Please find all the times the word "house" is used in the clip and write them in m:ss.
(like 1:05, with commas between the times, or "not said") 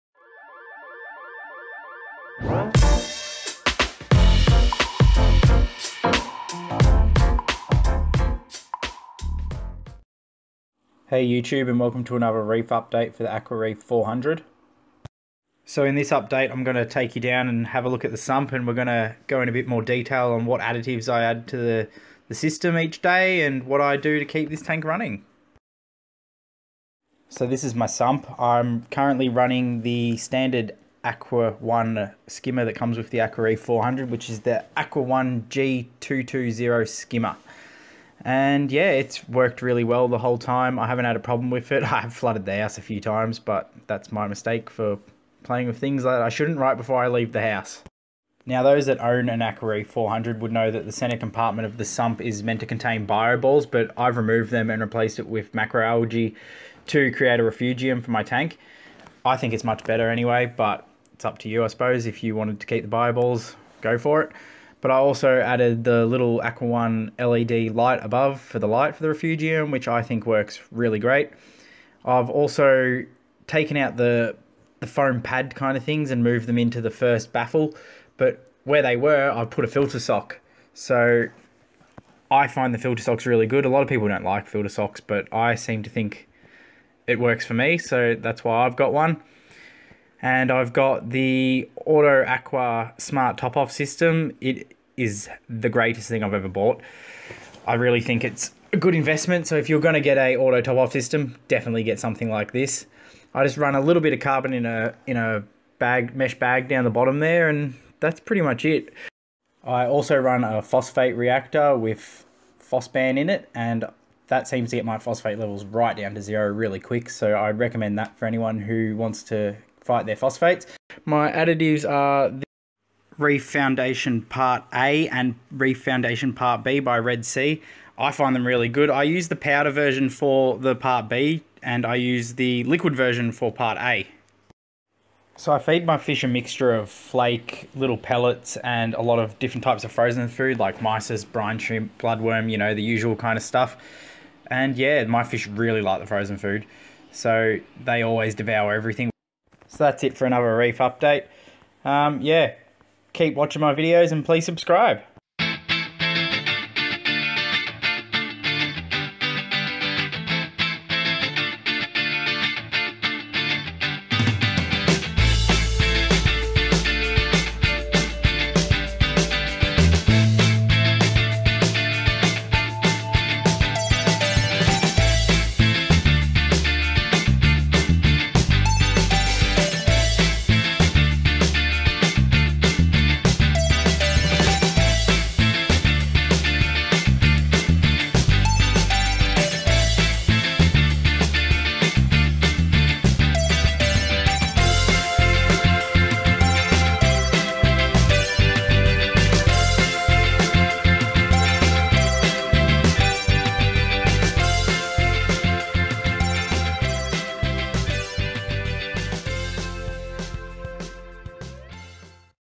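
0:42, 0:47.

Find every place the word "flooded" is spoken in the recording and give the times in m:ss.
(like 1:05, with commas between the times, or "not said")
0:42.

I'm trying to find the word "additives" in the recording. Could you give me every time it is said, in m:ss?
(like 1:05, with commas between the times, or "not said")
0:20, 2:01.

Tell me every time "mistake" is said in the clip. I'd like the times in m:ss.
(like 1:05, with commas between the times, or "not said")
0:44.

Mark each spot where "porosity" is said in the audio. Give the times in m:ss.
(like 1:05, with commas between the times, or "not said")
not said.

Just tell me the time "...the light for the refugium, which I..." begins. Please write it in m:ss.
1:08.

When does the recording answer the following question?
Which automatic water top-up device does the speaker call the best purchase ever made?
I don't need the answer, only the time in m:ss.
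1:31.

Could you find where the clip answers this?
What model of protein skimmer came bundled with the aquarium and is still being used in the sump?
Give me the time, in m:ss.
0:34.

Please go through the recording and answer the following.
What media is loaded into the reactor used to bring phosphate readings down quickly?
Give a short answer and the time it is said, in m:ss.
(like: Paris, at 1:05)
phosban, at 1:52.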